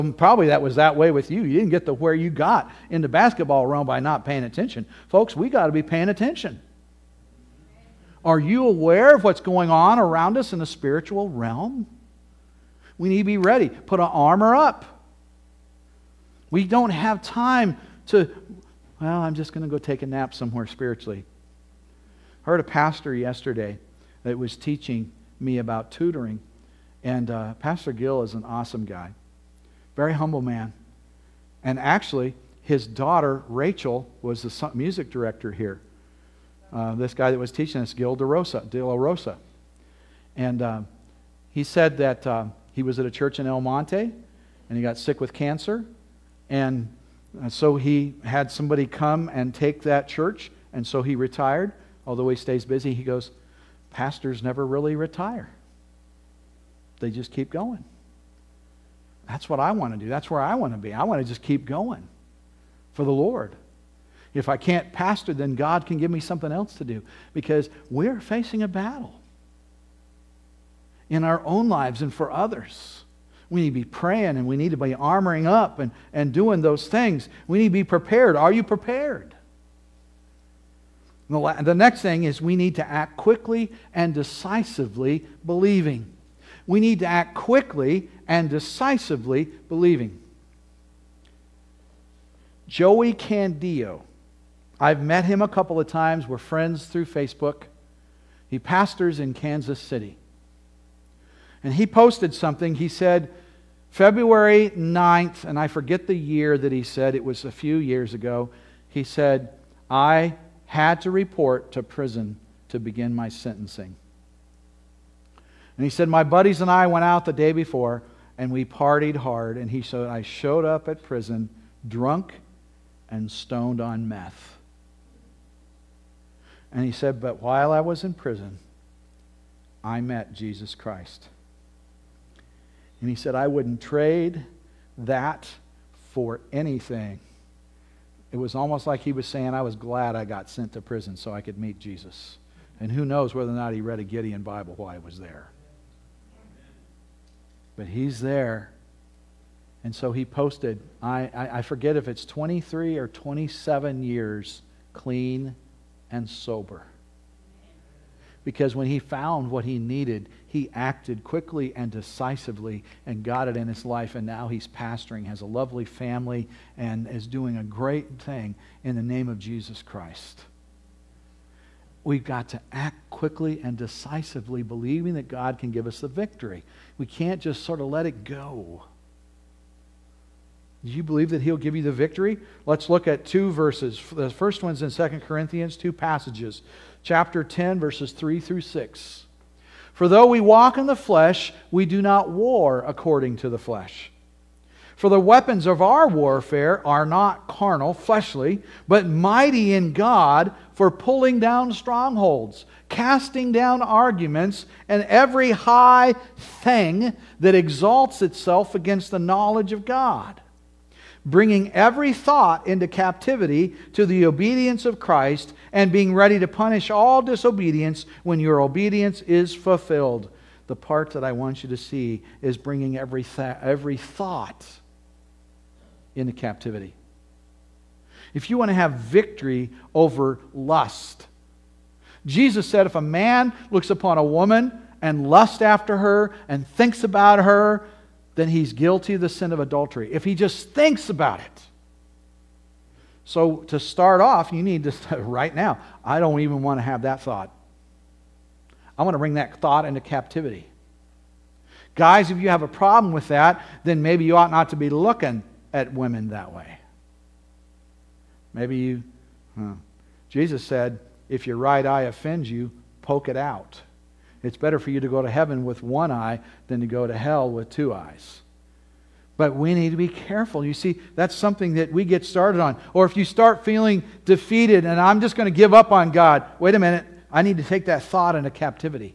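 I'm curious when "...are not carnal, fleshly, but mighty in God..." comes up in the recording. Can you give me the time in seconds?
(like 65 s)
196 s.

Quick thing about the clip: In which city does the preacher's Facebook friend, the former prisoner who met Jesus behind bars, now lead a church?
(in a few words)
Kansas City.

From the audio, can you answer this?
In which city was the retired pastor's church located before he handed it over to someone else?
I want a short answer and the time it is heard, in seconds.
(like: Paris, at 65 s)
El Monte, at 43 s.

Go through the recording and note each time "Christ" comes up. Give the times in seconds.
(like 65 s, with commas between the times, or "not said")
130 s, 169 s, 214 s.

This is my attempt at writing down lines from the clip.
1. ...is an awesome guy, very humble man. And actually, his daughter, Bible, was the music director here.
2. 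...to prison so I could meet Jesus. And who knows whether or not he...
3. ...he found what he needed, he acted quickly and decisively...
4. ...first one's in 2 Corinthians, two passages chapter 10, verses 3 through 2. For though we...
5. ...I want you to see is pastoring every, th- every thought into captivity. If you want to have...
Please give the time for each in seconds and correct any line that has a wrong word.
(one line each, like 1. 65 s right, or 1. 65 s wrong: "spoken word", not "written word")
1. 28 s wrong: "Rachel", not "Bible"
2. 140 s right
3. 158 s right
4. 184 s wrong: "6", not "2"
5. 221 s wrong: "bringing", not "pastoring".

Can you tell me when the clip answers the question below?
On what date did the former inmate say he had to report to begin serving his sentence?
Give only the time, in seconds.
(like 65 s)
103 s.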